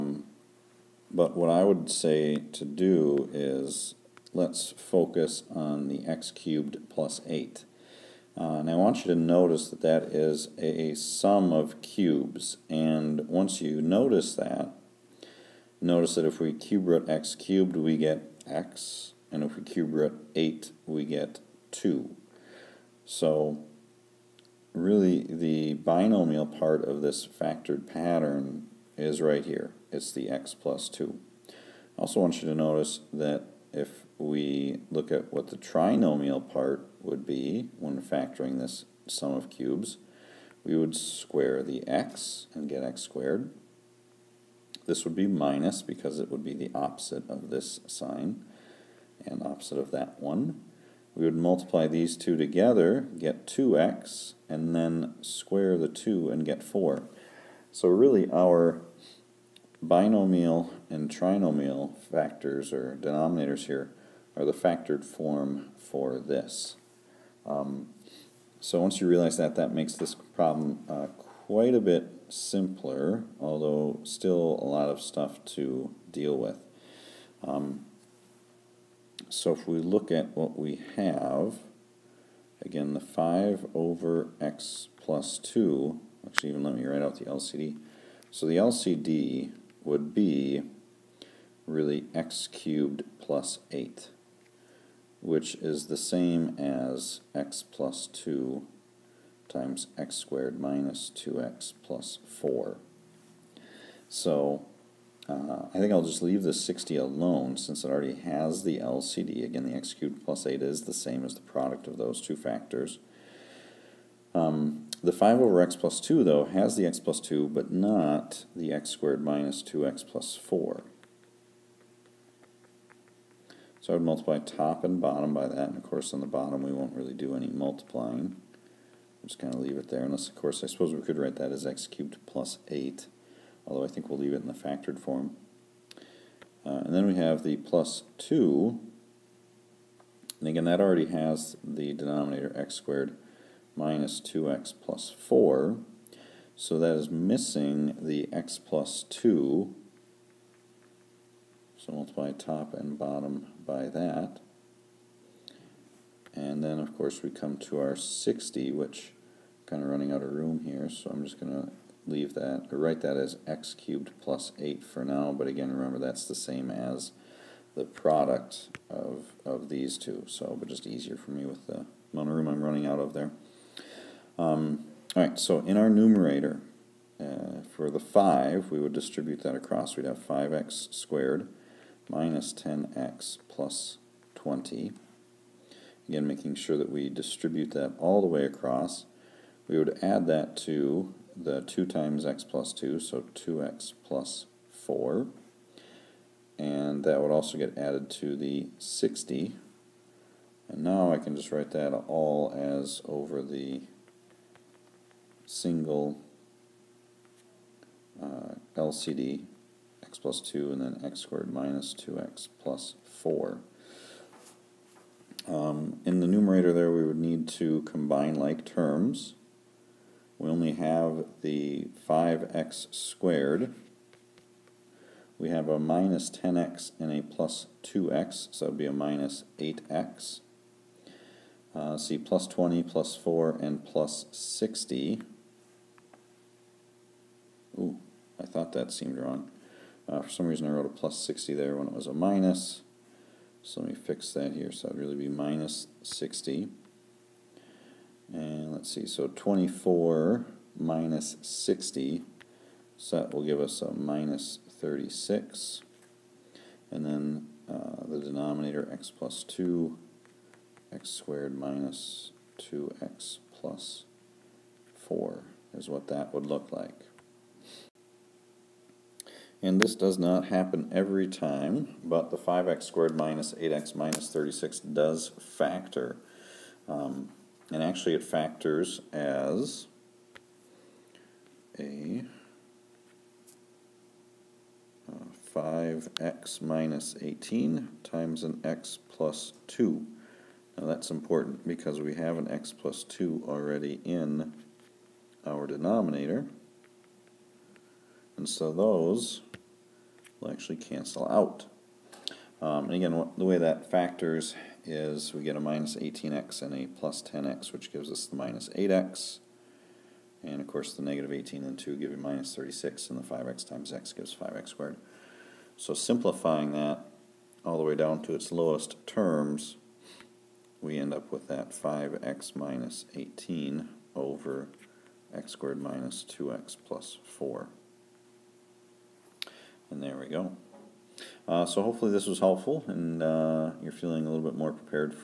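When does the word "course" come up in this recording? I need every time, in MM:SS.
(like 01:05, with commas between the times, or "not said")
02:05, 02:10, 02:36, 05:10.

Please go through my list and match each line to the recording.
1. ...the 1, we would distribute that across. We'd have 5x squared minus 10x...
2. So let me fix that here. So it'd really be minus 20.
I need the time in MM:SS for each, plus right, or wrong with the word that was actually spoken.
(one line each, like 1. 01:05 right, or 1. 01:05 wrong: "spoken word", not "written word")
1. 02:57 wrong: "5", not "1"
2. 04:03 wrong: "60", not "20".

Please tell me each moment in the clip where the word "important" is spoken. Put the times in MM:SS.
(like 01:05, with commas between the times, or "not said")
04:51.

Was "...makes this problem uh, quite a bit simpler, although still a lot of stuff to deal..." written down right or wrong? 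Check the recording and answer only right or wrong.
right.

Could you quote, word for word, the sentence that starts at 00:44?
This would be minus because it would be the opposite of this sign and opposite of that one.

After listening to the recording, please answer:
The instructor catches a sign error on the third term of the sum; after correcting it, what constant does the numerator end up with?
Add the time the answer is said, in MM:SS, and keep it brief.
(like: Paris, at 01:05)
-36, at 04:13.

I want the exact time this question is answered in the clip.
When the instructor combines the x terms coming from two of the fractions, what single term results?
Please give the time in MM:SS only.
03:48.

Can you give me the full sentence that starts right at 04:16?
And then uh, the denominator x plus 2, x squared minus 2x plus 4 is what that would look like.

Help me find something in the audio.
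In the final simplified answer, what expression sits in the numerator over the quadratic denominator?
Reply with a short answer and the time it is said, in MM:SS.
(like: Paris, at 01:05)
5x - 18, at 05:21.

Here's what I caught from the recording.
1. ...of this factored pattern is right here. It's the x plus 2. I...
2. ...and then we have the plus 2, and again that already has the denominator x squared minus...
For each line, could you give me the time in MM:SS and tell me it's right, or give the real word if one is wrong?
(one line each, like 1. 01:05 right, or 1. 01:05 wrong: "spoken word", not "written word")
1. 00:26 right
2. 02:16 right.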